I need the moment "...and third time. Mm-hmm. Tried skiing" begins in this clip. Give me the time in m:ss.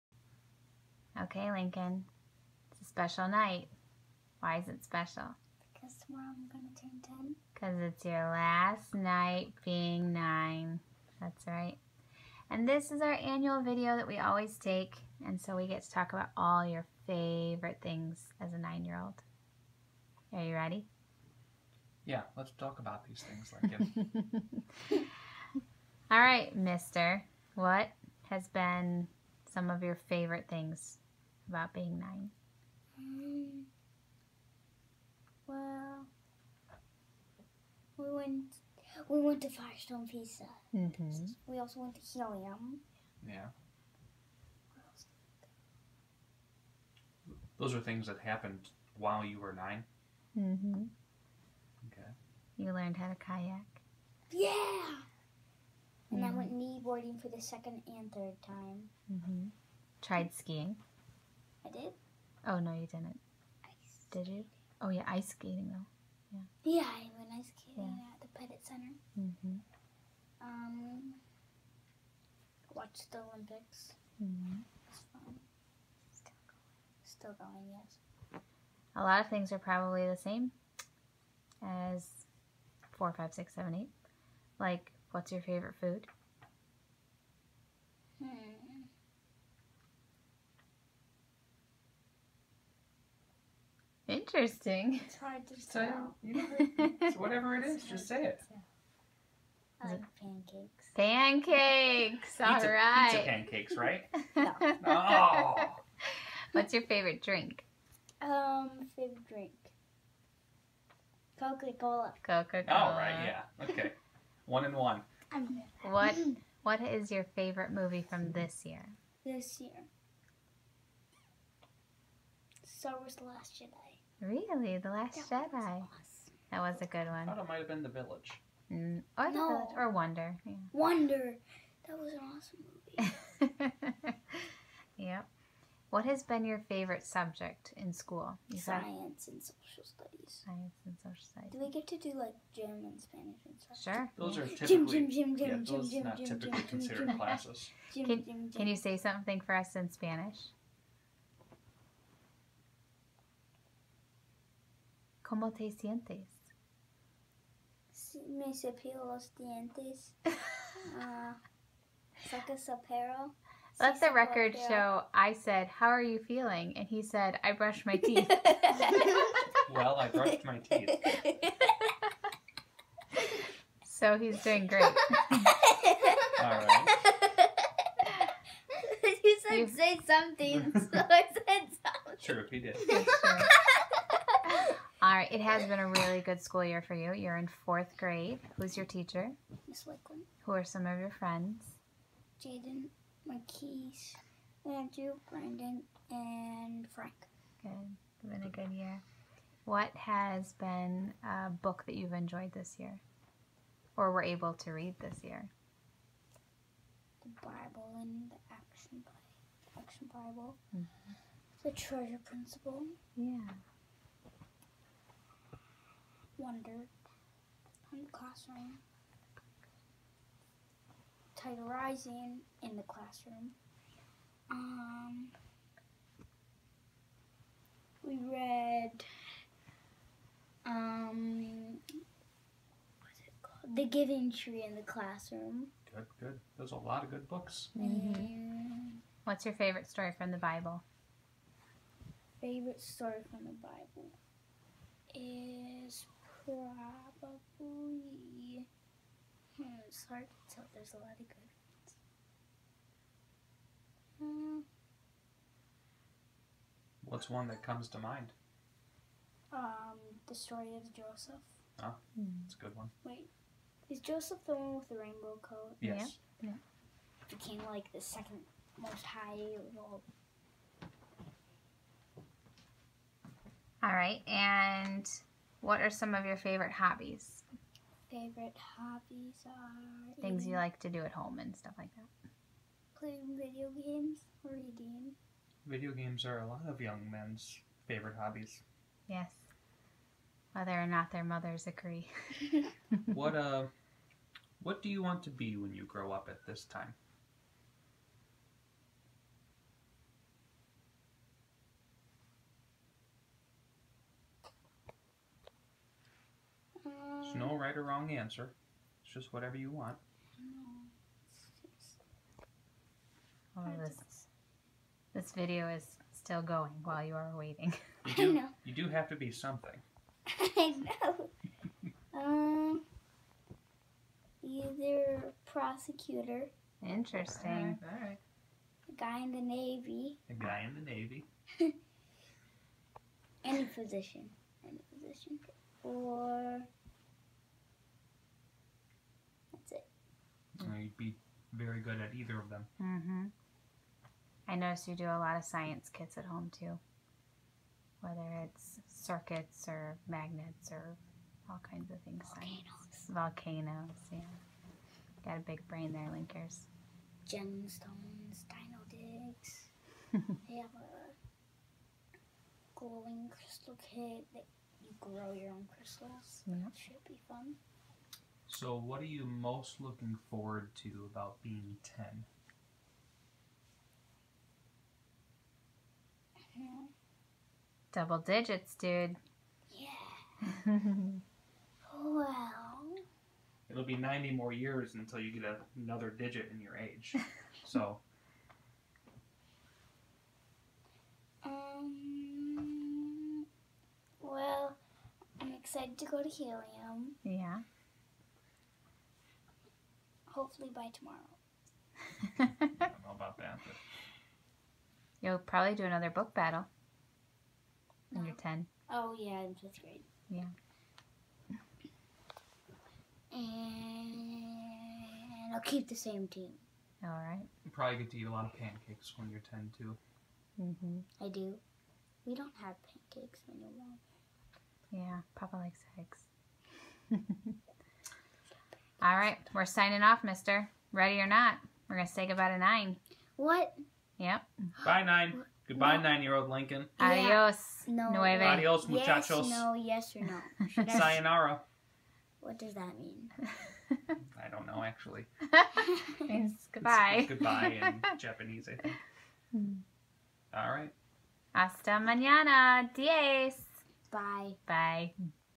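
0:57.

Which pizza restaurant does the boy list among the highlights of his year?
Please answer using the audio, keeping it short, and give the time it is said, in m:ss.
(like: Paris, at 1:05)
Firestone Pizza, at 0:39.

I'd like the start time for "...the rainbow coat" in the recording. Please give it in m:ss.
4:24.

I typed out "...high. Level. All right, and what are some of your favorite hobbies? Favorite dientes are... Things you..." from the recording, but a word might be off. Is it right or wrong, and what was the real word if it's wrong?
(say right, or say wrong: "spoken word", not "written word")
wrong: "hobbies", not "dientes".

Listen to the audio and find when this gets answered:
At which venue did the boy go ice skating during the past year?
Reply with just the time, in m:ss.
1:08.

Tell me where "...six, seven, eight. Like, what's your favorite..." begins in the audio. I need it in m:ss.
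1:23.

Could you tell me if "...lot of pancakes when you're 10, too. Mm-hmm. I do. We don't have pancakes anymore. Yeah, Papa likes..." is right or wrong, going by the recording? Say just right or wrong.
right.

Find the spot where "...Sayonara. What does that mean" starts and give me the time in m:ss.
7:20.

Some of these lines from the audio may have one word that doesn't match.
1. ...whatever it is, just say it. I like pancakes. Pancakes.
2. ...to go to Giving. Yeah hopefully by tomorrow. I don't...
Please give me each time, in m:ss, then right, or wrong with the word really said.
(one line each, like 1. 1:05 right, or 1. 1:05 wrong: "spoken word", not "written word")
1. 1:37 right
2. 6:35 wrong: "Helium", not "Giving".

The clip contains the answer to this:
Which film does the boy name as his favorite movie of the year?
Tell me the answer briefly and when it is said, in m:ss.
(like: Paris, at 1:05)
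Star Wars: The Last Jedi, at 2:02.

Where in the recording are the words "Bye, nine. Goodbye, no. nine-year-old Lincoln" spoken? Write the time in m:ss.
7:14.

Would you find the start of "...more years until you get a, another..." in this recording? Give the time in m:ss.
6:24.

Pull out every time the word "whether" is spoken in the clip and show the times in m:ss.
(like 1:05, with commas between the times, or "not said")
4:50, 5:48.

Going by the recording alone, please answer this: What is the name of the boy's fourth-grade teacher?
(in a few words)
Miss Lakeland.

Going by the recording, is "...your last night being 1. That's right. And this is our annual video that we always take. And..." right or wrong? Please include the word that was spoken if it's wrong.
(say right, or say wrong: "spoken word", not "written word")
wrong: "9", not "1".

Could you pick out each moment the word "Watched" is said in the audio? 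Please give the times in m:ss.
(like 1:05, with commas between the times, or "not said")
1:12.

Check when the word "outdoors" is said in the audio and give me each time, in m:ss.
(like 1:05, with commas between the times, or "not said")
not said.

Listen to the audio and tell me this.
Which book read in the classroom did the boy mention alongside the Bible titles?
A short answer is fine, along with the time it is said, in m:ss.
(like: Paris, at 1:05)
The Giving Tree, at 3:53.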